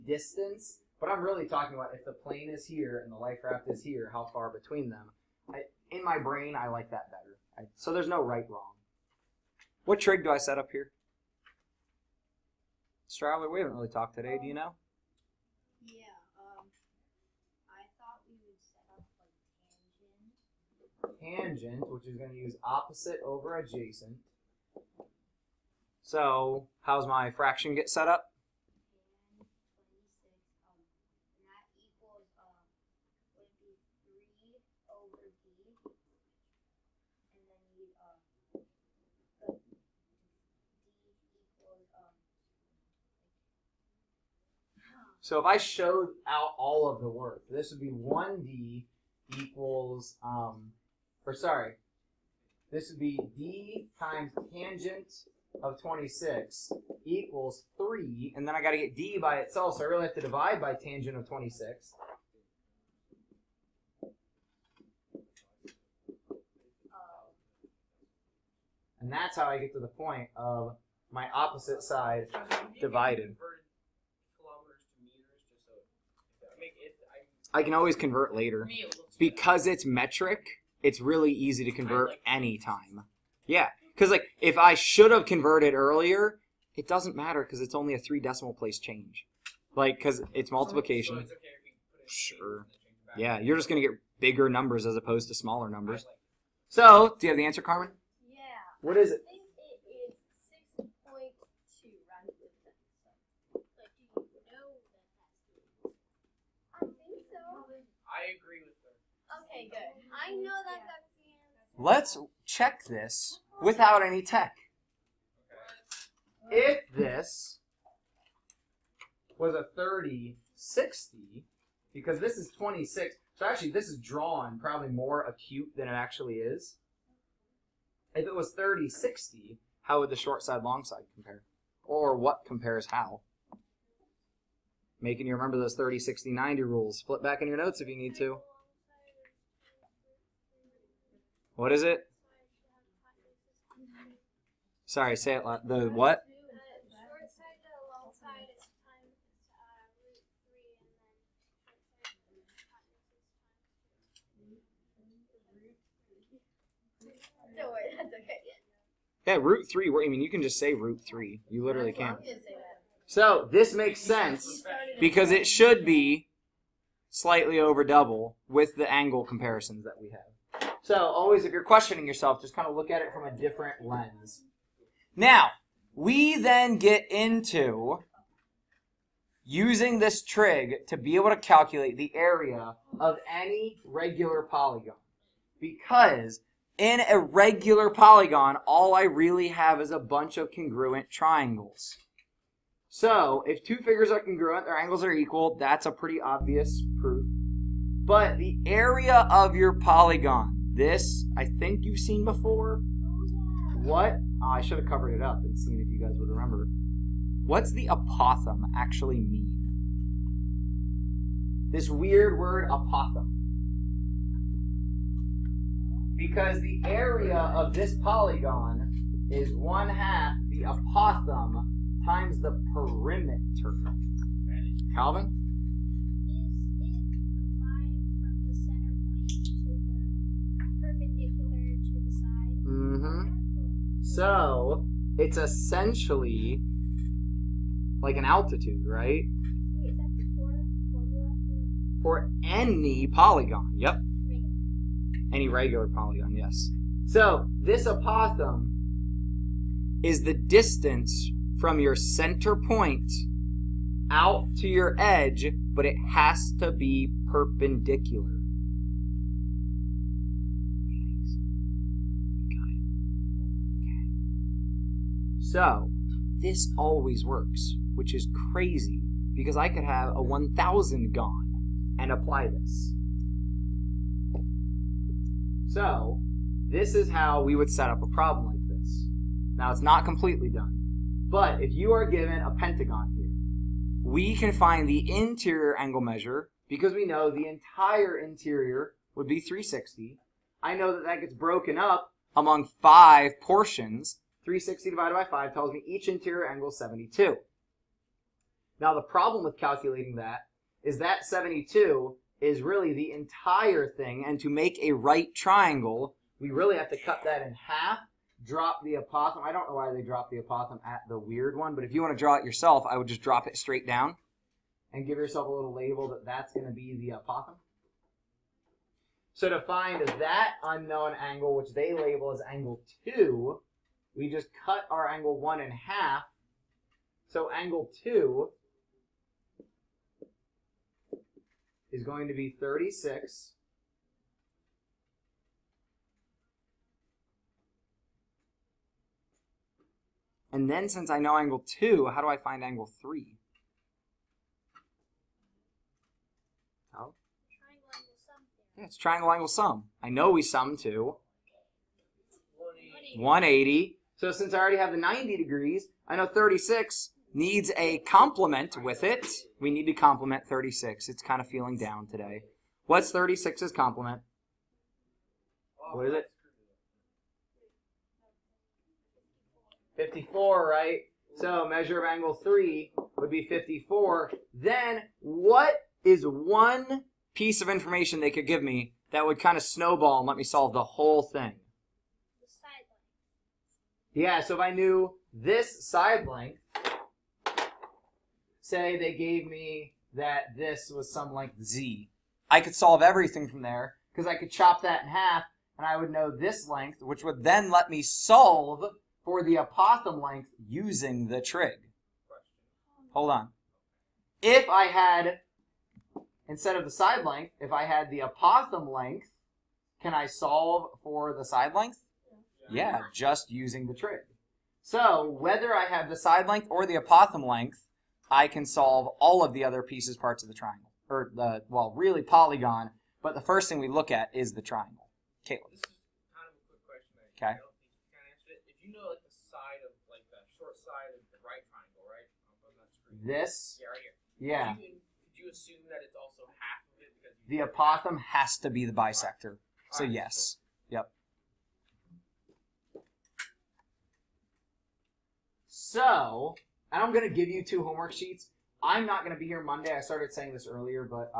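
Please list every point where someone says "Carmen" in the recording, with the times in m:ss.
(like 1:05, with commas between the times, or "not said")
1:37.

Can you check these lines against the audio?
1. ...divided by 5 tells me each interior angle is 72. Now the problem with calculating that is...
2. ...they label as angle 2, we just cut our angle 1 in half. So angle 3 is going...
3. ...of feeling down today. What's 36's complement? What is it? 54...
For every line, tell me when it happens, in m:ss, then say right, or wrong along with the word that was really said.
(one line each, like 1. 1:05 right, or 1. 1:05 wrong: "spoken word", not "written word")
1. 4:54 right
2. 5:21 wrong: "2", not "3"
3. 6:01 right.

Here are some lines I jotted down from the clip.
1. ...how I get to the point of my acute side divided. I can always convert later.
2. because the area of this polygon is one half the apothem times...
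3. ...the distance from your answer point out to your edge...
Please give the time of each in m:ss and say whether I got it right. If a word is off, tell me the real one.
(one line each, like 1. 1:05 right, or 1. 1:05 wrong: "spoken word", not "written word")
1. 1:09 wrong: "opposite", not "acute"
2. 3:36 right
3. 4:10 wrong: "center", not "answer".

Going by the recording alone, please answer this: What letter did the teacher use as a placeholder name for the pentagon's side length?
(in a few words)
z.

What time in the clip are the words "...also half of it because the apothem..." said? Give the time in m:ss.
7:16.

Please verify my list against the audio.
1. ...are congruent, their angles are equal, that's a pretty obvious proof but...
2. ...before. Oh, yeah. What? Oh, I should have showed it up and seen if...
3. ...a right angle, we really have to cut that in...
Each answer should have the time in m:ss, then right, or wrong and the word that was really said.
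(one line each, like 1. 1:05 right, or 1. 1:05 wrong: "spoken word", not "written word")
1. 3:14 right
2. 3:22 wrong: "covered", not "showed"
3. 5:04 wrong: "triangle", not "angle".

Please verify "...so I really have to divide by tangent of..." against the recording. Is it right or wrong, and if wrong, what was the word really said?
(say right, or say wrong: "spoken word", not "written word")
right.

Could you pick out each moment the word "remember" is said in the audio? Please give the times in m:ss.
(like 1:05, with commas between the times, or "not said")
2:15, 3:26.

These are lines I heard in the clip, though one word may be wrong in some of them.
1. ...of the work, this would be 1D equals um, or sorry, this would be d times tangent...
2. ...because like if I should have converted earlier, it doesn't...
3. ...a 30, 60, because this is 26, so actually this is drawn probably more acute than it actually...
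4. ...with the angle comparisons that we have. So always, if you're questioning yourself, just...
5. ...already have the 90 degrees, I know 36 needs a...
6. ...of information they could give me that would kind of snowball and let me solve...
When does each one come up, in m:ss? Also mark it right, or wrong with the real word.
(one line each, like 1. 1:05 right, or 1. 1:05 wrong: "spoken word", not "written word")
1. 0:46 right
2. 1:23 right
3. 1:59 right
4. 2:48 right
5. 5:54 right
6. 6:17 right.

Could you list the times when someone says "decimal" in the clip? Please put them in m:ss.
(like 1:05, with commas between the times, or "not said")
1:28.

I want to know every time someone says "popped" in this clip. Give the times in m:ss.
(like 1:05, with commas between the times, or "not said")
not said.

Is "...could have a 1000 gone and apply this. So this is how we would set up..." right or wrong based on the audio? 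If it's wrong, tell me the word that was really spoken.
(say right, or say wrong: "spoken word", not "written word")
right.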